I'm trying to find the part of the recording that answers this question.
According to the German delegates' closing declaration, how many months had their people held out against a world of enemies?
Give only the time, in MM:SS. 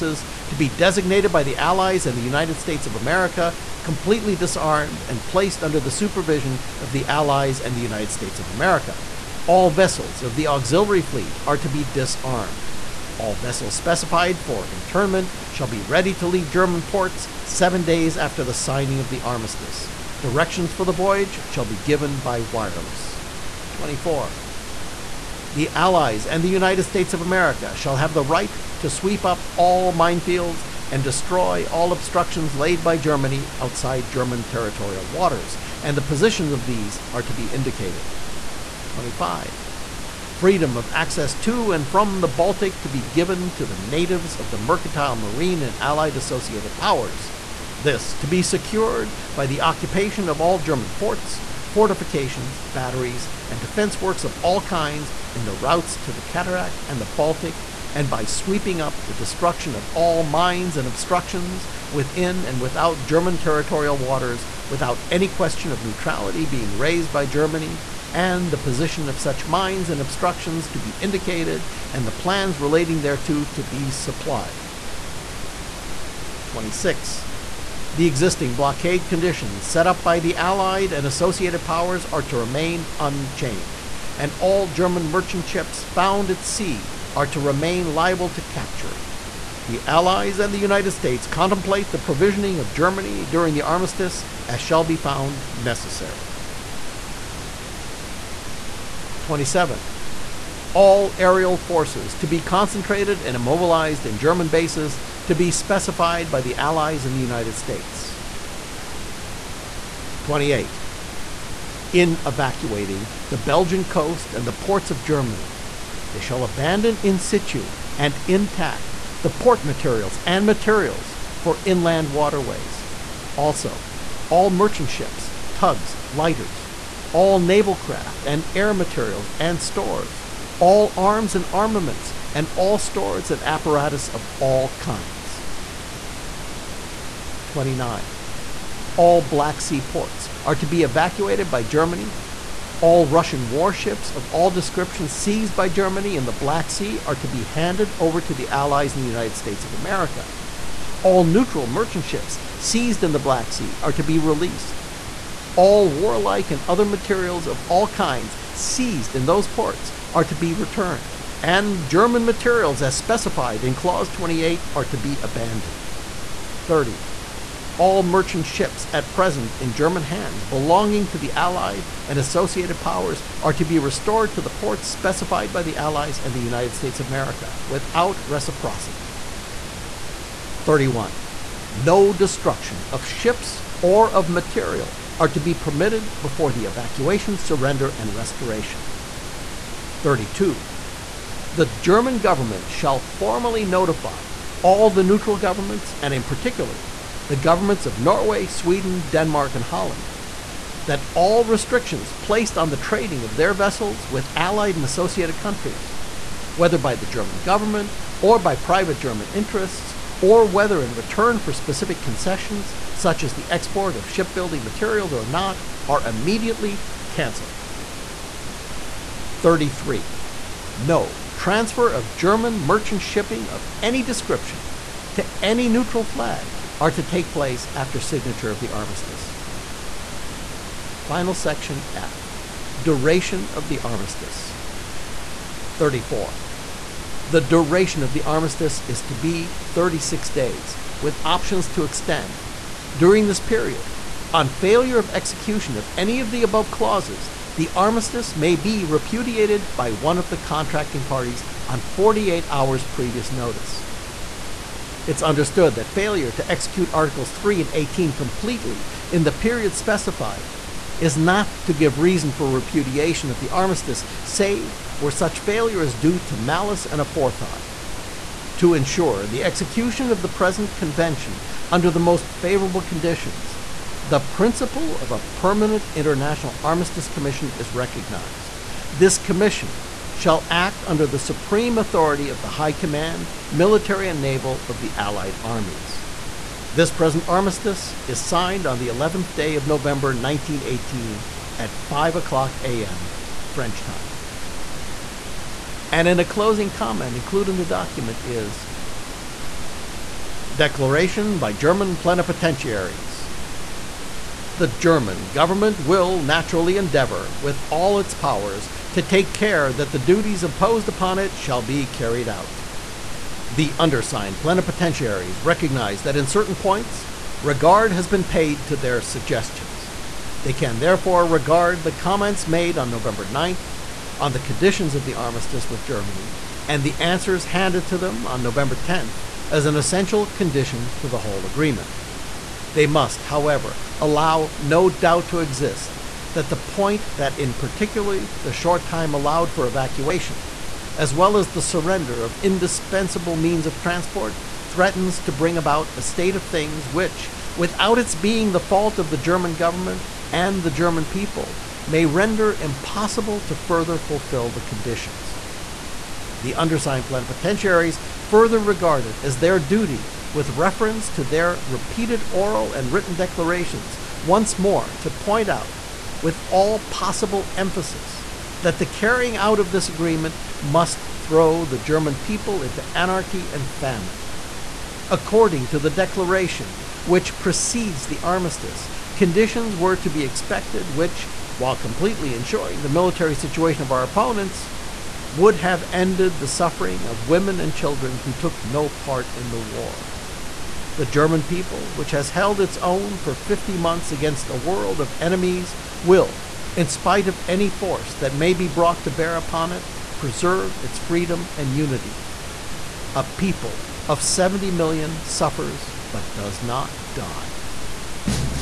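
06:33.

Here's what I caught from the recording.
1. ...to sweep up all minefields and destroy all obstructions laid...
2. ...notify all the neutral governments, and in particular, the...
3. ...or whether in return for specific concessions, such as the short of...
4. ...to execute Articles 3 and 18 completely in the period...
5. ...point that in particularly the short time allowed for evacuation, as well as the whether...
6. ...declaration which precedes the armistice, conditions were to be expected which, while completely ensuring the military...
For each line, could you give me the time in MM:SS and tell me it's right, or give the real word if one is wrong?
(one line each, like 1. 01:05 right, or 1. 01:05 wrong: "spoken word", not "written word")
1. 00:28 right
2. 03:13 right
3. 03:30 wrong: "export", not "short"
4. 04:16 right
5. 05:36 wrong: "surrender", not "whether"
6. 06:15 right.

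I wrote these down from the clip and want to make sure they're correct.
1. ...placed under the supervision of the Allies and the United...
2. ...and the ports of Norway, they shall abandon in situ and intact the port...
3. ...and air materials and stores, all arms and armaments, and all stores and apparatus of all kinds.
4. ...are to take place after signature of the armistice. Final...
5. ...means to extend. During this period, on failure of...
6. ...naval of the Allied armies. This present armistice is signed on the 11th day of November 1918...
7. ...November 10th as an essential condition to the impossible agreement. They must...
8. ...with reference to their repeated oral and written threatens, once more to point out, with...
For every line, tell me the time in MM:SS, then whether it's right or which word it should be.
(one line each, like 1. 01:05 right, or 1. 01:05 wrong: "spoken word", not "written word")
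1. 00:05 right
2. 01:54 wrong: "Germany", not "Norway"
3. 02:08 right
4. 03:46 right
5. 04:01 wrong: "options", not "means"
6. 04:44 right
7. 05:28 wrong: "whole", not "impossible"
8. 06:00 wrong: "declarations", not "threatens".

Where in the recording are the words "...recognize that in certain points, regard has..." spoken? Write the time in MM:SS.
05:15.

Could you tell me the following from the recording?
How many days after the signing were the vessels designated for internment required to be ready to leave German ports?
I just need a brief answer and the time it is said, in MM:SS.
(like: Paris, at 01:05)
7 days, at 00:17.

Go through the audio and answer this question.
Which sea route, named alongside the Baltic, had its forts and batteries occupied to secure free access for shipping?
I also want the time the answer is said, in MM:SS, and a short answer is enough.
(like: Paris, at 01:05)
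Cattegat, at 00:56.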